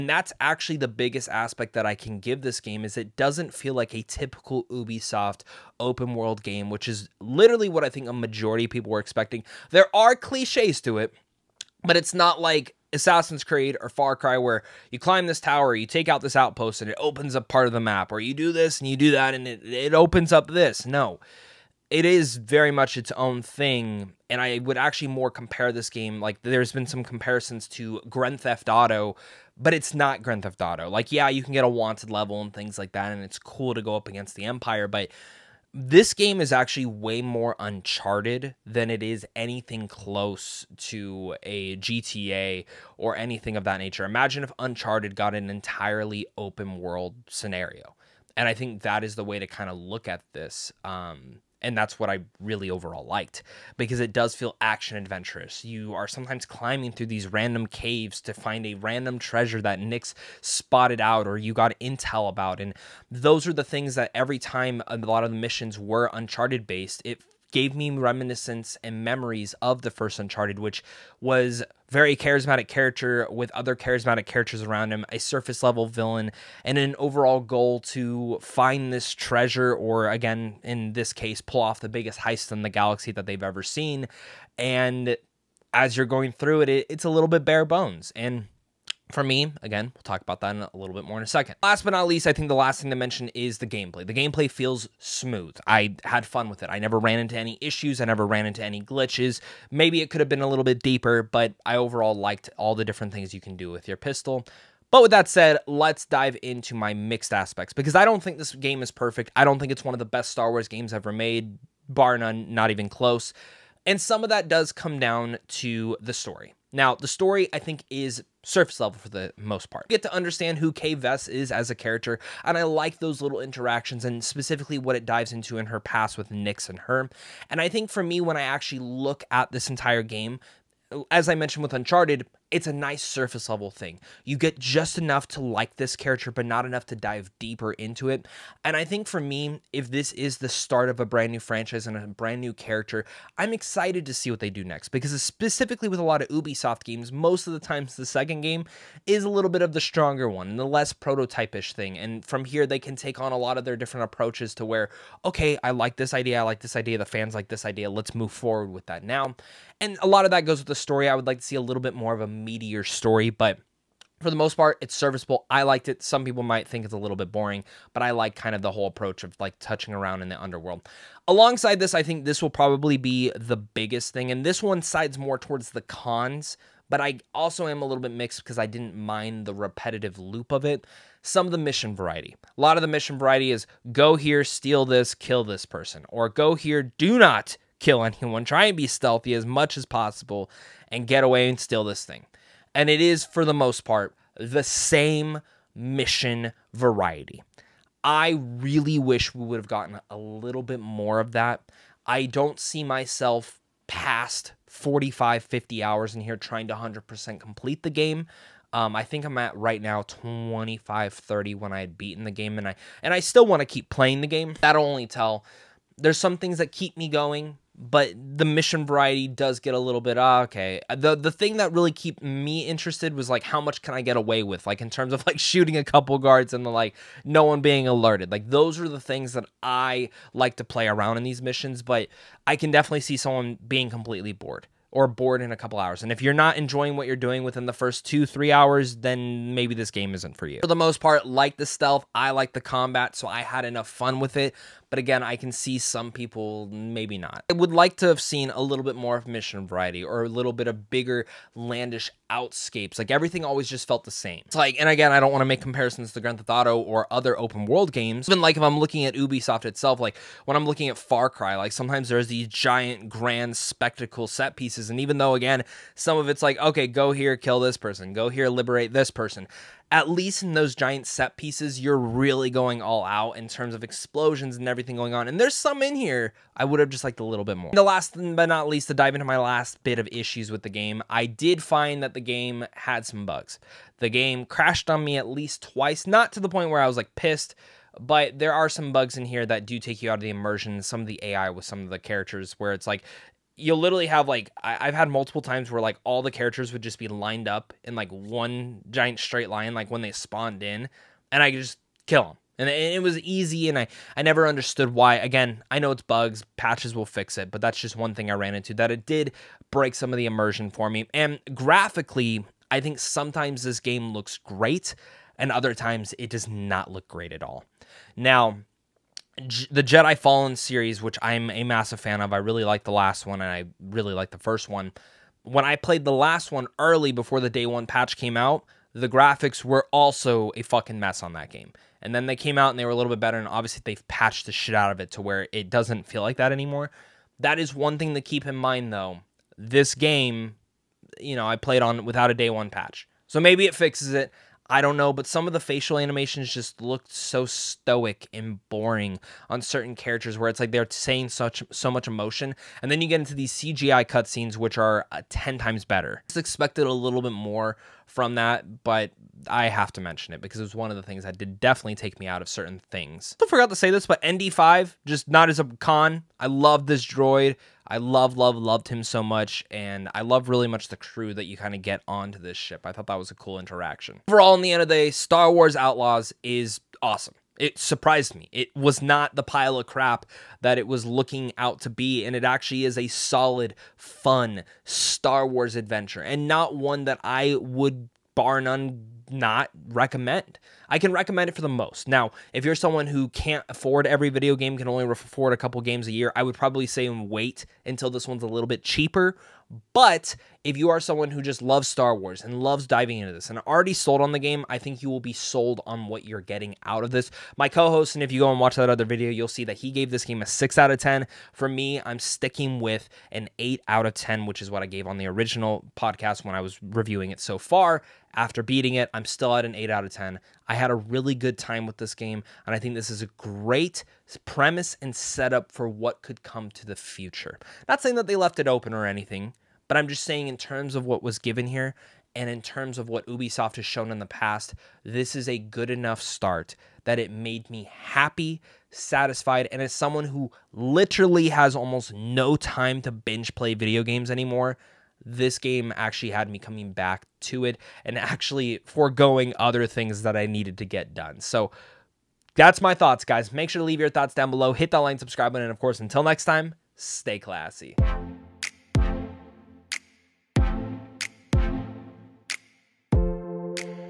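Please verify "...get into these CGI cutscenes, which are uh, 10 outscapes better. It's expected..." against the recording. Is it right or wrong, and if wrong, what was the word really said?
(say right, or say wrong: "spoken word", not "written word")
wrong: "times", not "outscapes".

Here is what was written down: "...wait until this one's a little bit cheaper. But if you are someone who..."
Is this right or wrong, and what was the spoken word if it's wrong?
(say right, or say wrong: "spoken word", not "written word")
right.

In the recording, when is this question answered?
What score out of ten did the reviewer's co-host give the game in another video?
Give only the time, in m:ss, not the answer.
6:50.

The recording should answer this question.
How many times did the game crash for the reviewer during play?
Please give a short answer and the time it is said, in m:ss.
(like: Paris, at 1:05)
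2, at 4:45.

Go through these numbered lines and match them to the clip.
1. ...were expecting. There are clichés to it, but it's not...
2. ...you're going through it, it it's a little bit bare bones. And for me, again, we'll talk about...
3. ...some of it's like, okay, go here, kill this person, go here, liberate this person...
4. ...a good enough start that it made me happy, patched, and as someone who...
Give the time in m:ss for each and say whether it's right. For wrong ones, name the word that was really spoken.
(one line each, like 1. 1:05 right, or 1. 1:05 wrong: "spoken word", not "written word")
1. 0:08 right
2. 1:25 right
3. 4:25 right
4. 7:15 wrong: "satisfied", not "patched".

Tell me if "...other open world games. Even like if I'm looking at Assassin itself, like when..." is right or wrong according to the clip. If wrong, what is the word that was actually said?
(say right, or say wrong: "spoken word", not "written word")
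wrong: "Ubisoft", not "Assassin".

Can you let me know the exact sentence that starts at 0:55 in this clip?
You are sometimes climbing through these random caves to find a random treasure that Nix spotted out or you got intel about.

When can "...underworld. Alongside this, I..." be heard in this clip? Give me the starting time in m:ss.
2:50.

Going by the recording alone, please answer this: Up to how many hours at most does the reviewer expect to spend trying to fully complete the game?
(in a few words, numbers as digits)
50.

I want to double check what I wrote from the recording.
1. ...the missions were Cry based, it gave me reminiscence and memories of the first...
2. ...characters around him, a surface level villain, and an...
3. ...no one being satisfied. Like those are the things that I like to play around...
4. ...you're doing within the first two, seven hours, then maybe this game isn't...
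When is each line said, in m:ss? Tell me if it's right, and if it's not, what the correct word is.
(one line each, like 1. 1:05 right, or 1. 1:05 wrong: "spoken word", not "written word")
1. 1:05 wrong: "Uncharted", not "Cry"
2. 1:14 right
3. 3:47 wrong: "alerted", not "satisfied"
4. 3:57 wrong: "three", not "seven".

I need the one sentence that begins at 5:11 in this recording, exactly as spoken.
And graphically, I think sometimes this game looks great, and other times it does not look great at all.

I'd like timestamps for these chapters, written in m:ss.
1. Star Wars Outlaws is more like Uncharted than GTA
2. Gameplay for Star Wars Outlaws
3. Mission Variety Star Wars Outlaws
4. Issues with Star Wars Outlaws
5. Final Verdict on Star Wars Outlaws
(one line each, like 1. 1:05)
1. 0:33
2. 1:29
3. 2:49
4. 4:44
5. 6:19.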